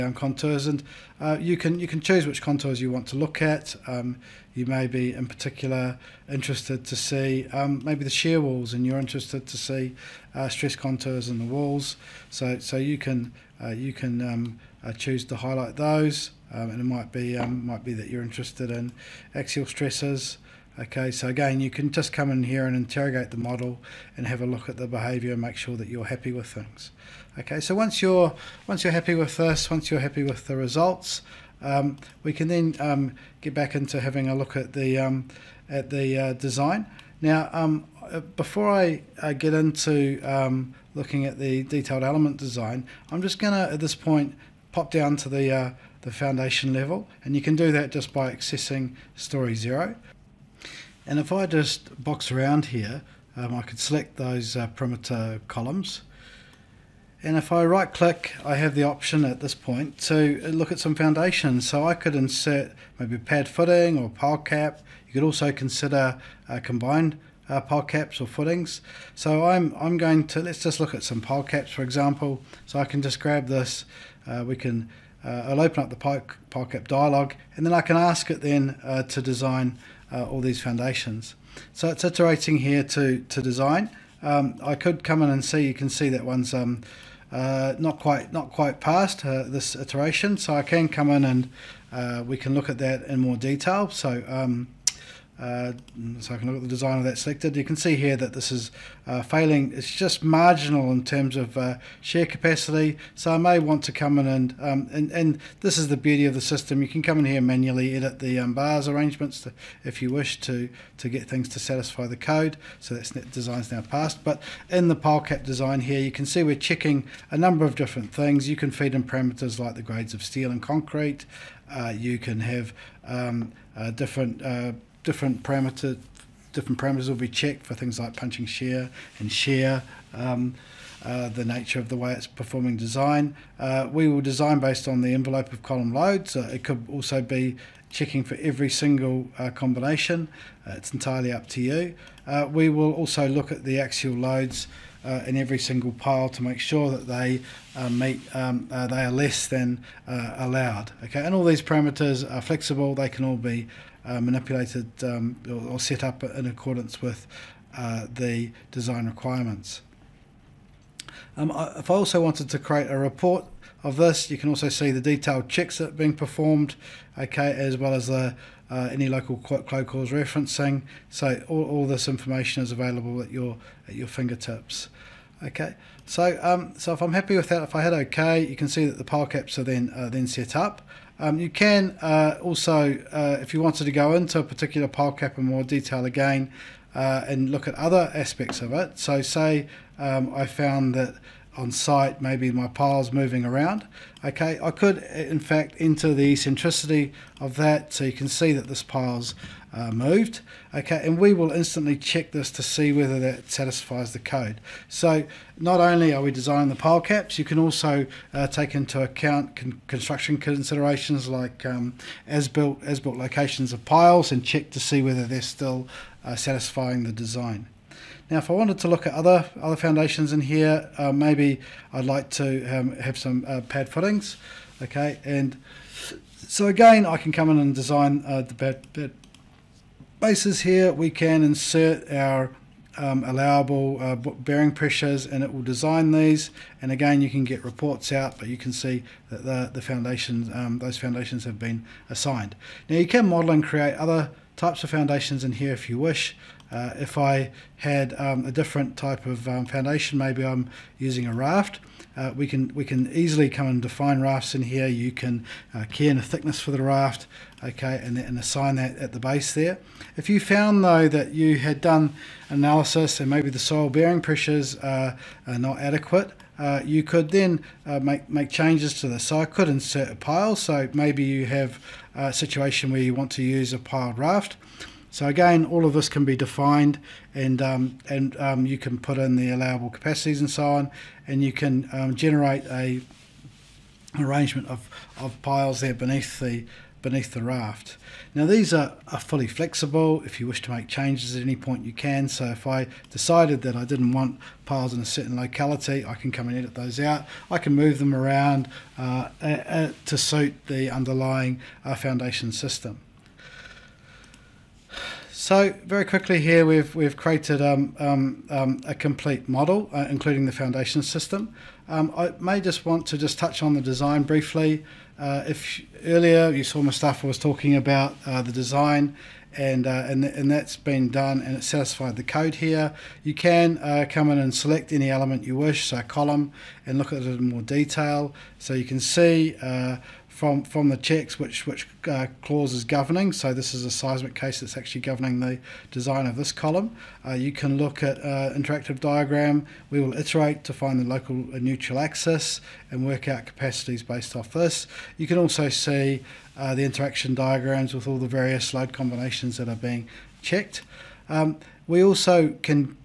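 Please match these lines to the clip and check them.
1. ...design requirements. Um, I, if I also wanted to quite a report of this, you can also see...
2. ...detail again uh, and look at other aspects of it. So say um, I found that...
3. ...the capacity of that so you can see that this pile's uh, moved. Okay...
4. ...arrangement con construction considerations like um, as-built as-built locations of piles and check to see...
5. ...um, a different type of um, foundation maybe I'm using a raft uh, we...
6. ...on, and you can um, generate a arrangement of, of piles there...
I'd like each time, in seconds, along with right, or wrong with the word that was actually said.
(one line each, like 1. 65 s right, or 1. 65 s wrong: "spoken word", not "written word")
1. 158 s wrong: "create", not "quite"
2. 185 s right
3. 196 s wrong: "eccentricity", not "capacity"
4. 209 s wrong: "account", not "arrangement"
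5. 248 s right
6. 280 s right.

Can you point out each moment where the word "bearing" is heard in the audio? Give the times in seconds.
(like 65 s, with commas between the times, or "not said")
234 s, 263 s.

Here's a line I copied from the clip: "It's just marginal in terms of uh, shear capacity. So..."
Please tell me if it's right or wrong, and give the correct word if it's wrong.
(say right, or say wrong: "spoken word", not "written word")
right.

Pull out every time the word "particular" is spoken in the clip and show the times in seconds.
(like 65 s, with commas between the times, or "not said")
5 s, 184 s.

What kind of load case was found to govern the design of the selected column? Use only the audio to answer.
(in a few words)
Seismic case.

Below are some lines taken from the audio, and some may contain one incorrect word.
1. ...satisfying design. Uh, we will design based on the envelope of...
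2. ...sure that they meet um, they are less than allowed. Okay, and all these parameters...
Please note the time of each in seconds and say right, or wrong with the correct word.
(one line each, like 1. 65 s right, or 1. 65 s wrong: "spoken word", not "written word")
1. 132 s wrong: "performing", not "satisfying"
2. 146 s right.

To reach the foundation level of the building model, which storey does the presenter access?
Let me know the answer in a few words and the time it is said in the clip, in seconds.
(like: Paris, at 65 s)
Story zero, at 49 s.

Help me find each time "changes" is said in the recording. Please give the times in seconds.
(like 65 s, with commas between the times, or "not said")
268 s, 290 s.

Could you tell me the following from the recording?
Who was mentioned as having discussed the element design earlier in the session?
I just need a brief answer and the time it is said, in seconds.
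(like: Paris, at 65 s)
Mustafa, at 316 s.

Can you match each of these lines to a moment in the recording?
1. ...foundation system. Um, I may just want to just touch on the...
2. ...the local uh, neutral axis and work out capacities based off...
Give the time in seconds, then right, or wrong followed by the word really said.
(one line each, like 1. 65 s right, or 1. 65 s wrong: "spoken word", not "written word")
1. 310 s right
2. 340 s right.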